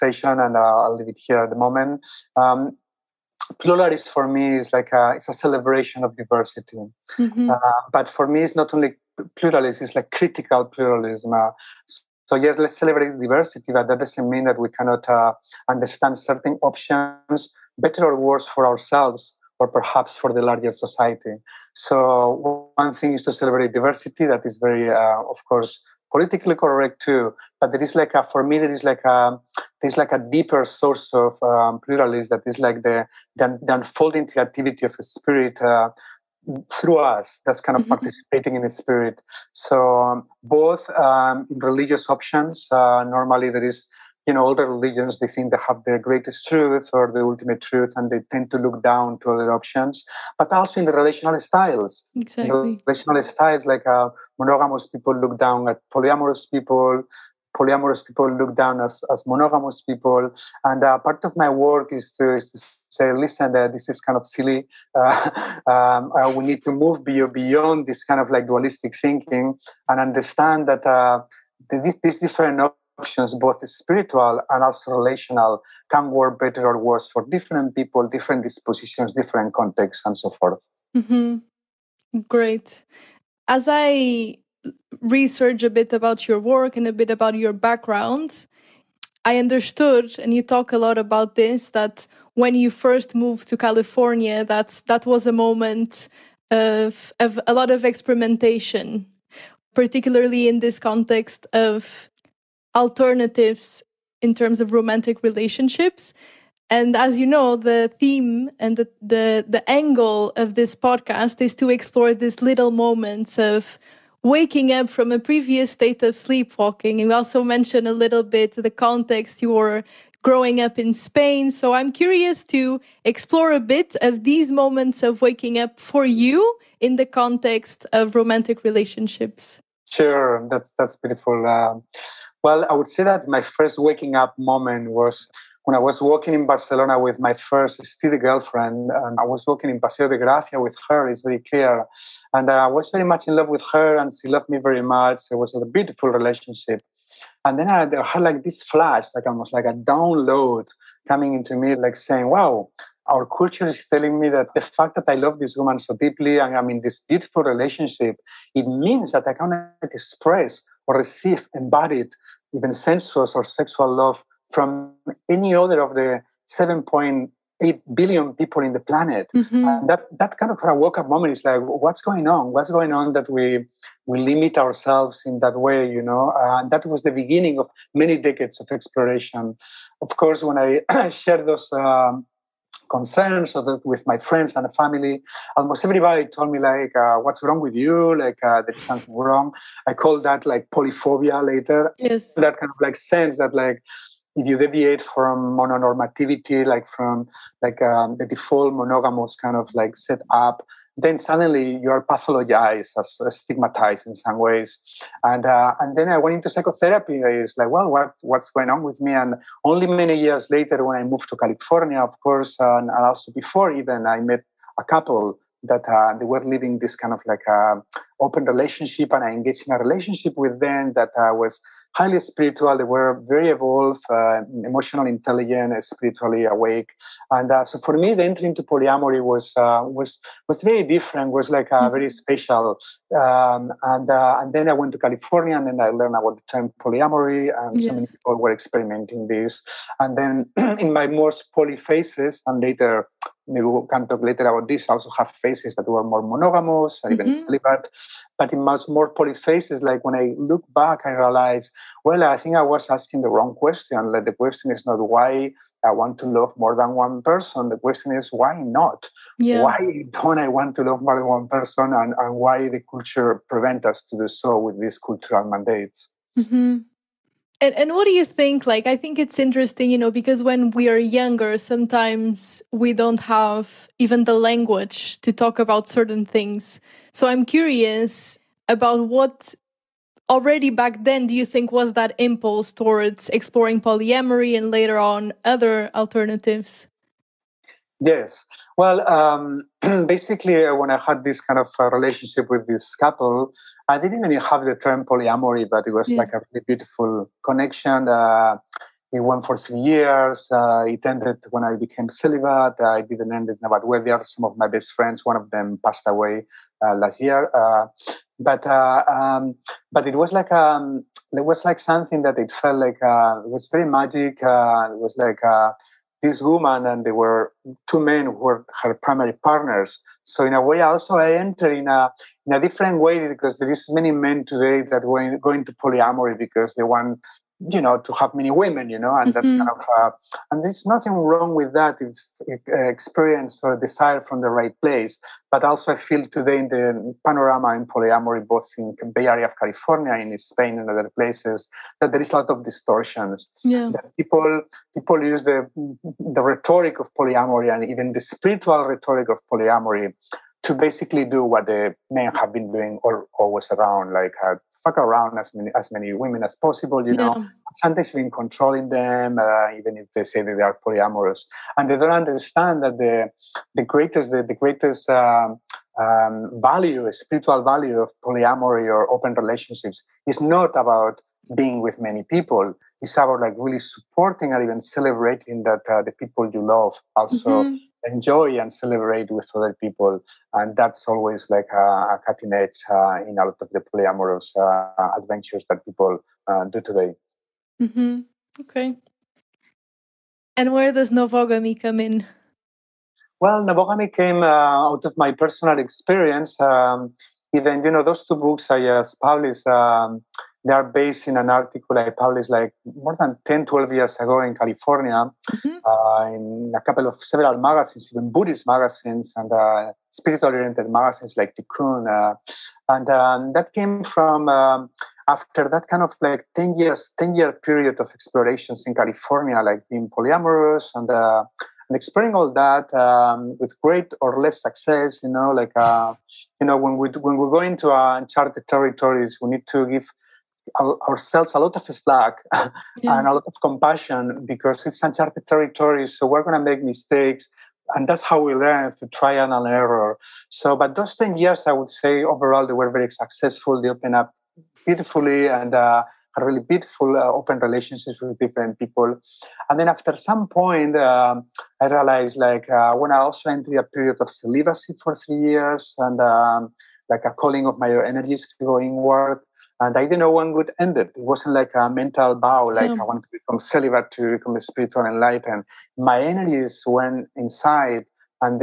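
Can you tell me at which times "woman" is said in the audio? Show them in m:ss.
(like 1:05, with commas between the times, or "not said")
2:35, 5:16.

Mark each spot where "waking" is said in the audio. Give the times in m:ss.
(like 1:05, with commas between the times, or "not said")
1:54, 2:05, 2:13.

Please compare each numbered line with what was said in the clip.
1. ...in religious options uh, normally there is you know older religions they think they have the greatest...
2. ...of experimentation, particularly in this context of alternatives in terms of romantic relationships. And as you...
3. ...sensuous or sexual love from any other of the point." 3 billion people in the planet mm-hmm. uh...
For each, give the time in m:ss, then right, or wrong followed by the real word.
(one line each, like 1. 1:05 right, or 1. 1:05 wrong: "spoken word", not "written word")
1. 0:41 right
2. 1:37 right
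3. 2:42 wrong: "8", not "3".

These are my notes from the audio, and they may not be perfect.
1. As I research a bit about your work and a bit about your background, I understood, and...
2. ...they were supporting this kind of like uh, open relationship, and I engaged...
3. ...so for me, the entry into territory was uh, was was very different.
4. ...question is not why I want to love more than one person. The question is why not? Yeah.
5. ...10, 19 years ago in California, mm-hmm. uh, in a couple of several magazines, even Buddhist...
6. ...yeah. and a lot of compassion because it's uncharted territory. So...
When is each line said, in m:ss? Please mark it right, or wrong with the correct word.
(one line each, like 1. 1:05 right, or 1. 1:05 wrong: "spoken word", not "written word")
1. 1:23 right
2. 3:36 wrong: "living", not "supporting"
3. 3:47 wrong: "polyamory", not "territory"
4. 4:14 right
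5. 6:43 wrong: "12", not "19"
6. 7:12 right.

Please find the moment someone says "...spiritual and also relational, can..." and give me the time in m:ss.
1:13.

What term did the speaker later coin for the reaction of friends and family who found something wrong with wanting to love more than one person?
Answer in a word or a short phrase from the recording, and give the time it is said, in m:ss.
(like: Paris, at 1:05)
polyphobia, at 3:10.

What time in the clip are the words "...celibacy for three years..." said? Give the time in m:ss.
7:34.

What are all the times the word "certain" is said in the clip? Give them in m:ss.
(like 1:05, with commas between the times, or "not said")
0:16, 4:35.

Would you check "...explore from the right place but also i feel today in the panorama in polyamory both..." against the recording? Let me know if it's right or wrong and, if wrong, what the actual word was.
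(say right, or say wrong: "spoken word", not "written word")
wrong: "desire", not "explore".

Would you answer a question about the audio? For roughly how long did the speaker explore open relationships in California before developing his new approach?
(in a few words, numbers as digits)
10 years.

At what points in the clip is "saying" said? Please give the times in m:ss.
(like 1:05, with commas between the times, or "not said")
2:31.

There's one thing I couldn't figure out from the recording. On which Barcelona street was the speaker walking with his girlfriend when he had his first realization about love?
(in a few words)
Paseo de Gracia.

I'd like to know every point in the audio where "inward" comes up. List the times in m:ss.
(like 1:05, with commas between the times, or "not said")
7:38.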